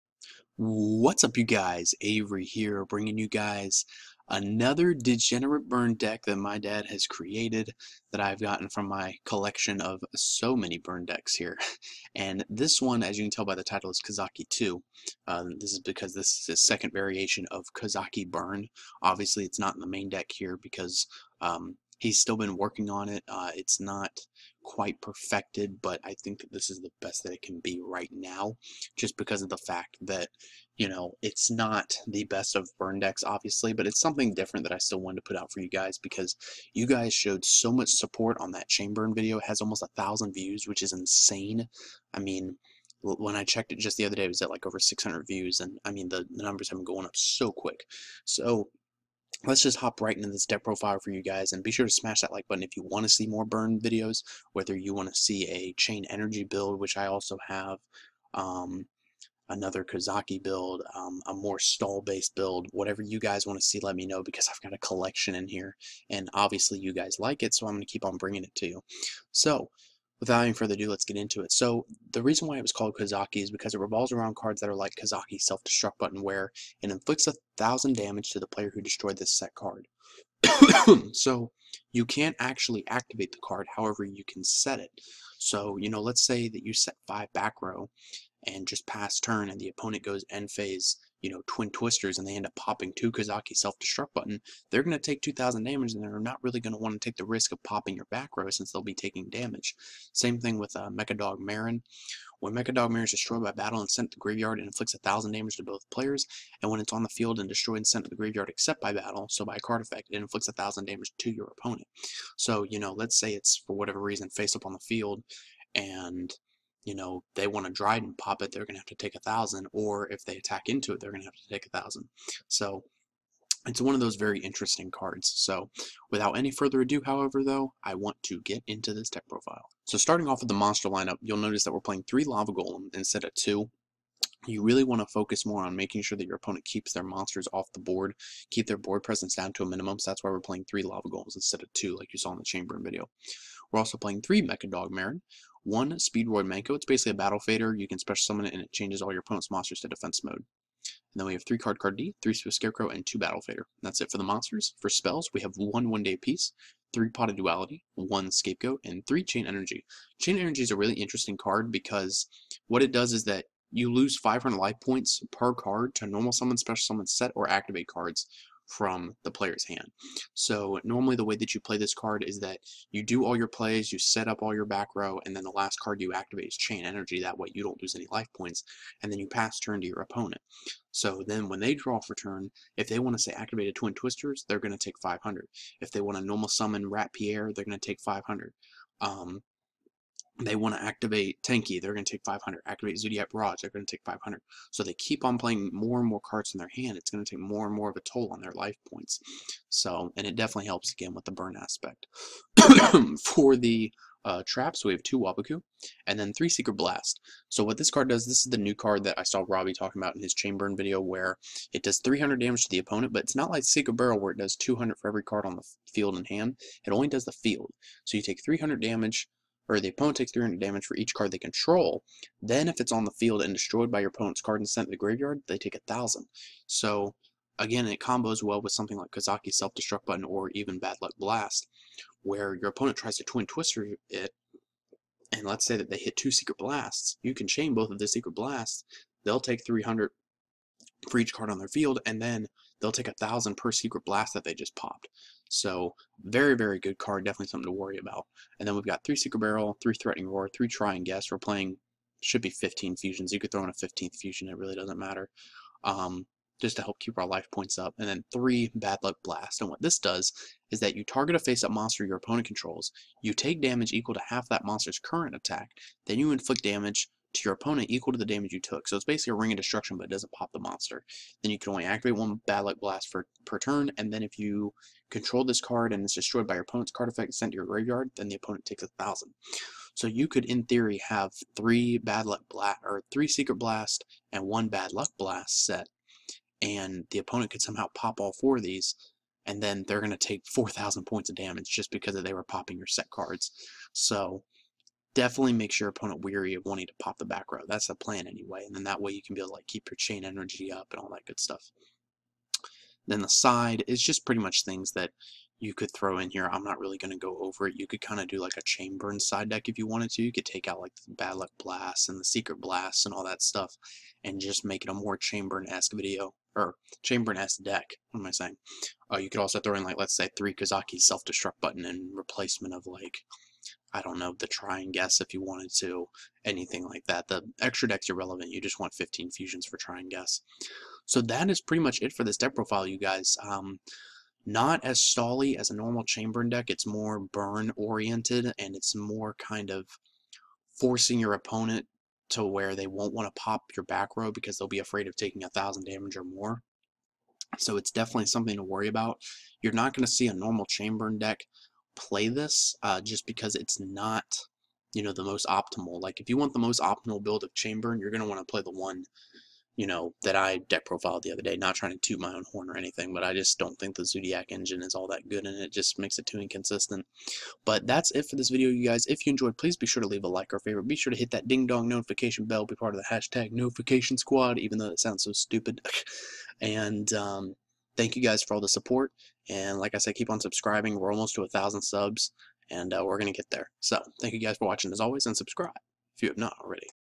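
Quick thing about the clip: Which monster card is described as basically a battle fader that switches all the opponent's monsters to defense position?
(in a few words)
Speedroid Menko.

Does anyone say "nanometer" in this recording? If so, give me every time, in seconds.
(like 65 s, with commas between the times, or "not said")
not said.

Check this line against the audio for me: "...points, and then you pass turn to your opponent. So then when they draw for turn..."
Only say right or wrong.
right.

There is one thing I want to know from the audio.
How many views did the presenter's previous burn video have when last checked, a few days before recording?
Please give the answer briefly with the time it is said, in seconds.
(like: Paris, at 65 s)
over 600, at 44 s.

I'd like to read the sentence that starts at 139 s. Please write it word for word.
So that's why we're playing three Lava Golems instead of two, like you saw in the chain burn video.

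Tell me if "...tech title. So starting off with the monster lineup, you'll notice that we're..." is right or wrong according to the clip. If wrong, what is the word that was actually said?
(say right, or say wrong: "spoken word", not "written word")
wrong: "profile", not "title".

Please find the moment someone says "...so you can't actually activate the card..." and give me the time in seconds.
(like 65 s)
81 s.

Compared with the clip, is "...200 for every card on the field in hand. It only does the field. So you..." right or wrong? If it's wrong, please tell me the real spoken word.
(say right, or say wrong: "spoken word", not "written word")
right.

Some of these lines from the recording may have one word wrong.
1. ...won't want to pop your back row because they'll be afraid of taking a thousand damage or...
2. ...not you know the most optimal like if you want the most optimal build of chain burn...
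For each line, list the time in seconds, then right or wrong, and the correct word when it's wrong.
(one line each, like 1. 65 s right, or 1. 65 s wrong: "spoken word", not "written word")
1. 342 s right
2. 353 s right.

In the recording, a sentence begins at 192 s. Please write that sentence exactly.
Activate Zodiac Barrage, they're going to take 500.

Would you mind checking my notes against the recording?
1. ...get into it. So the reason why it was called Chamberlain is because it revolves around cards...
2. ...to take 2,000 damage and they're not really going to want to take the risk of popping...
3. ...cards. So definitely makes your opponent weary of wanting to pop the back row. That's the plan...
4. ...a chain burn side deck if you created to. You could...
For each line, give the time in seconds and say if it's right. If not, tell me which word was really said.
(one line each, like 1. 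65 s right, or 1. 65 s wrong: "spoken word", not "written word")
1. 71 s wrong: "Kozaky", not "Chamberlain"
2. 94 s right
3. 293 s right
4. 308 s wrong: "wanted", not "created".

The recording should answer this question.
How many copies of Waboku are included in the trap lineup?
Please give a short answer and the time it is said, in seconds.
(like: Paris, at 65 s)
2, at 205 s.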